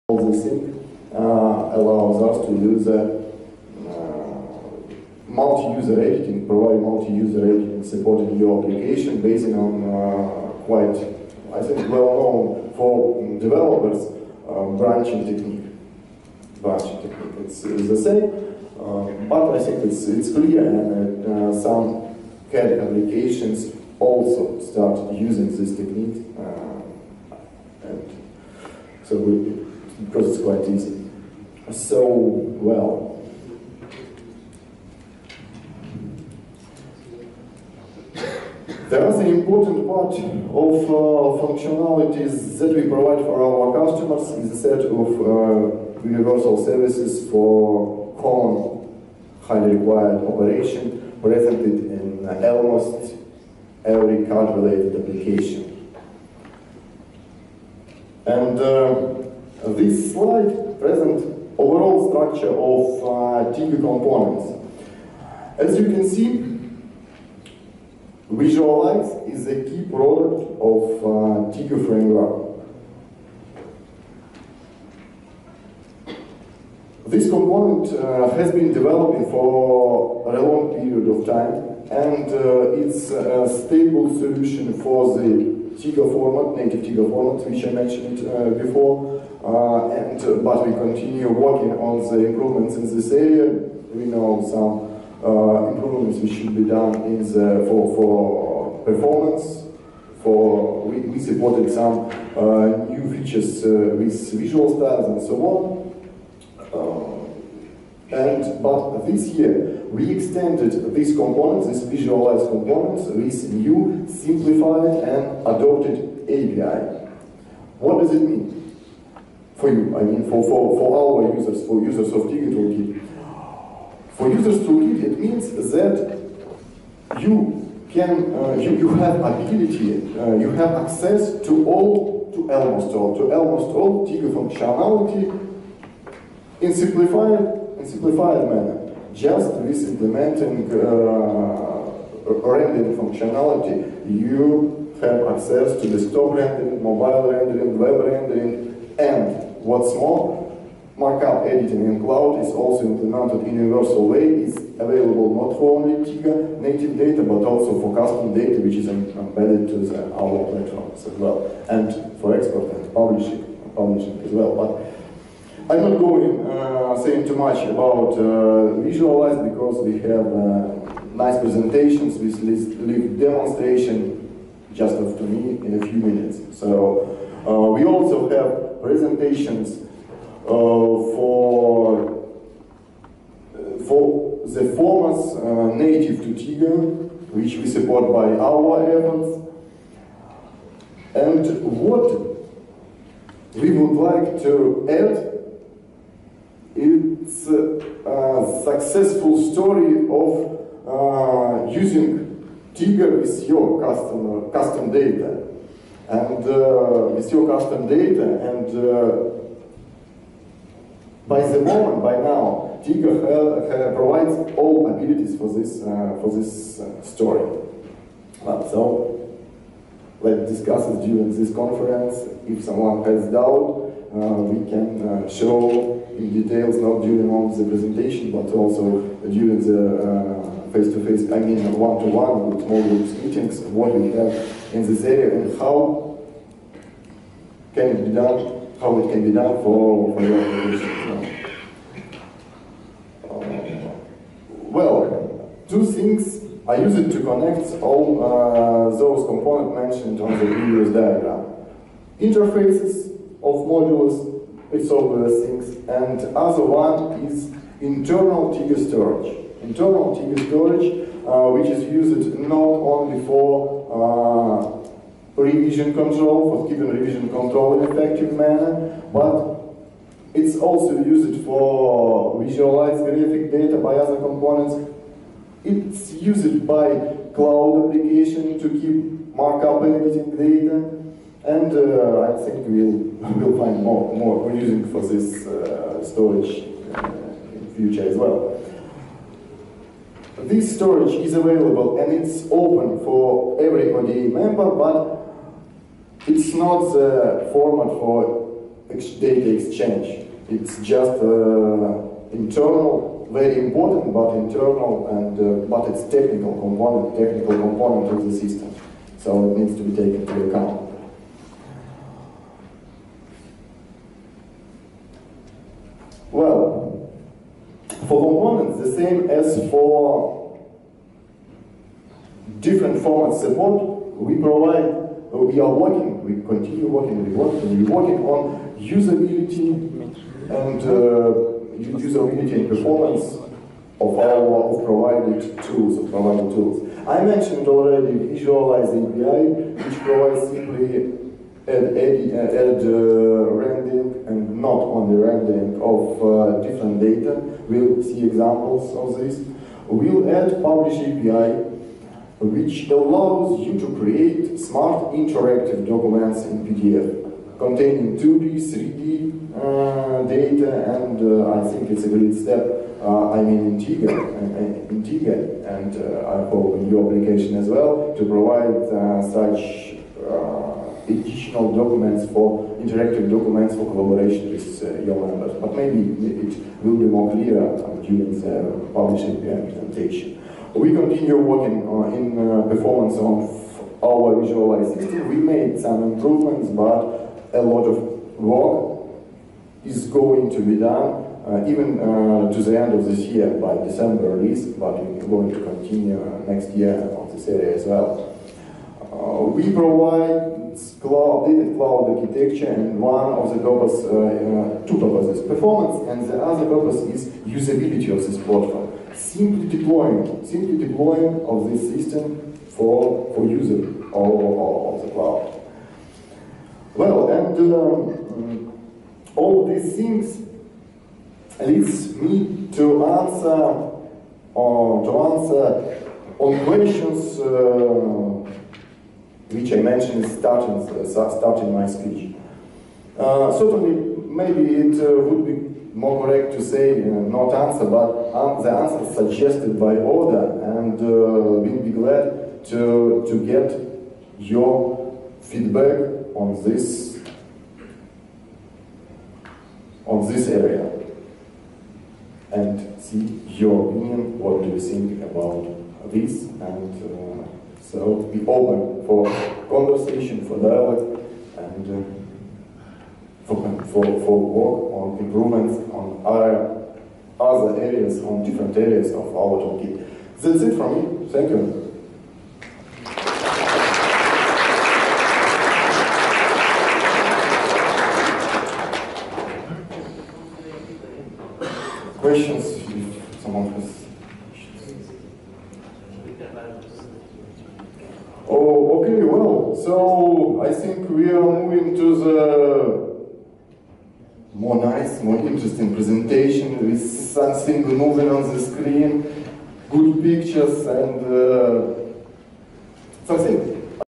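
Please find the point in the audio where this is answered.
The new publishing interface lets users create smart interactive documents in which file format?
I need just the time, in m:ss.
5:56.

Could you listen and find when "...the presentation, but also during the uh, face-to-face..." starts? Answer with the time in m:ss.
3:47.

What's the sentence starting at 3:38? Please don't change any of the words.
But so let's discuss it during this conference.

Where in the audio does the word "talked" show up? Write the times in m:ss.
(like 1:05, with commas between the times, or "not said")
not said.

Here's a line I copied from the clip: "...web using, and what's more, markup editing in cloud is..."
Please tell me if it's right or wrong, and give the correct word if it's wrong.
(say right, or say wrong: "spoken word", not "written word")
wrong: "rendering", not "using".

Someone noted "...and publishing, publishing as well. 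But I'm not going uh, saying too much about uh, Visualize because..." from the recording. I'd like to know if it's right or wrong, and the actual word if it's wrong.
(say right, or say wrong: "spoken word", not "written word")
right.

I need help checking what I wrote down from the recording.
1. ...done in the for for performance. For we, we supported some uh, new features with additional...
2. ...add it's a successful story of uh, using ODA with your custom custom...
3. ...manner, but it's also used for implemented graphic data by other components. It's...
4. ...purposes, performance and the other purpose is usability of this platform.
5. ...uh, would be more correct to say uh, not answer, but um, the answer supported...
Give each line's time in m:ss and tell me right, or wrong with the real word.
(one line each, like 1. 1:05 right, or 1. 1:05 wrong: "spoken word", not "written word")
1. 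1:36 wrong: "visual", not "additional"
2. 3:14 wrong: "Teigha", not "ODA"
3. 4:28 wrong: "visualized", not "implemented"
4. 6:44 right
5. 7:15 wrong: "suggested", not "supported".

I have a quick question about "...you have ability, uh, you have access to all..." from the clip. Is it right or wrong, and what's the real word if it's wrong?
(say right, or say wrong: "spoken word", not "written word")
right.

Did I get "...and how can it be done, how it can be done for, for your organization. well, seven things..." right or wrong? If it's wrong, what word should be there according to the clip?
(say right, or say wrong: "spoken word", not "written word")
wrong: "two", not "seven".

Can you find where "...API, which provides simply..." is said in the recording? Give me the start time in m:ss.
5:38.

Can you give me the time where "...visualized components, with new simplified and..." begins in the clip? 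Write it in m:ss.
1:51.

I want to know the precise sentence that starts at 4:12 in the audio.
Interfaces, of modules it's all those things.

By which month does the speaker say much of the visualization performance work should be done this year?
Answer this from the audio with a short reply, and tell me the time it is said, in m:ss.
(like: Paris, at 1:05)
December, at 6:33.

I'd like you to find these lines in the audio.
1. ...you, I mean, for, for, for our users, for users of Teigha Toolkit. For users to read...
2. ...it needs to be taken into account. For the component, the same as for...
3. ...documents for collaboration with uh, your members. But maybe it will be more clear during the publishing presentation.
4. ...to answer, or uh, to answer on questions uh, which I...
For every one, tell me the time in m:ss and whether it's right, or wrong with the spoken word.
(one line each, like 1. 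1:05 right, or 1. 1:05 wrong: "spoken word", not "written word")
1. 1:59 right
2. 5:09 wrong: "moment", not "component"
3. 6:13 right
4. 7:02 right.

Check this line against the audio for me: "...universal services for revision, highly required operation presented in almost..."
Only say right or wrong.
wrong.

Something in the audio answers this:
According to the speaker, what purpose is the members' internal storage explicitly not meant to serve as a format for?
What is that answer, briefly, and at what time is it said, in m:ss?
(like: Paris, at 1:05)
Data exchange, at 4:58.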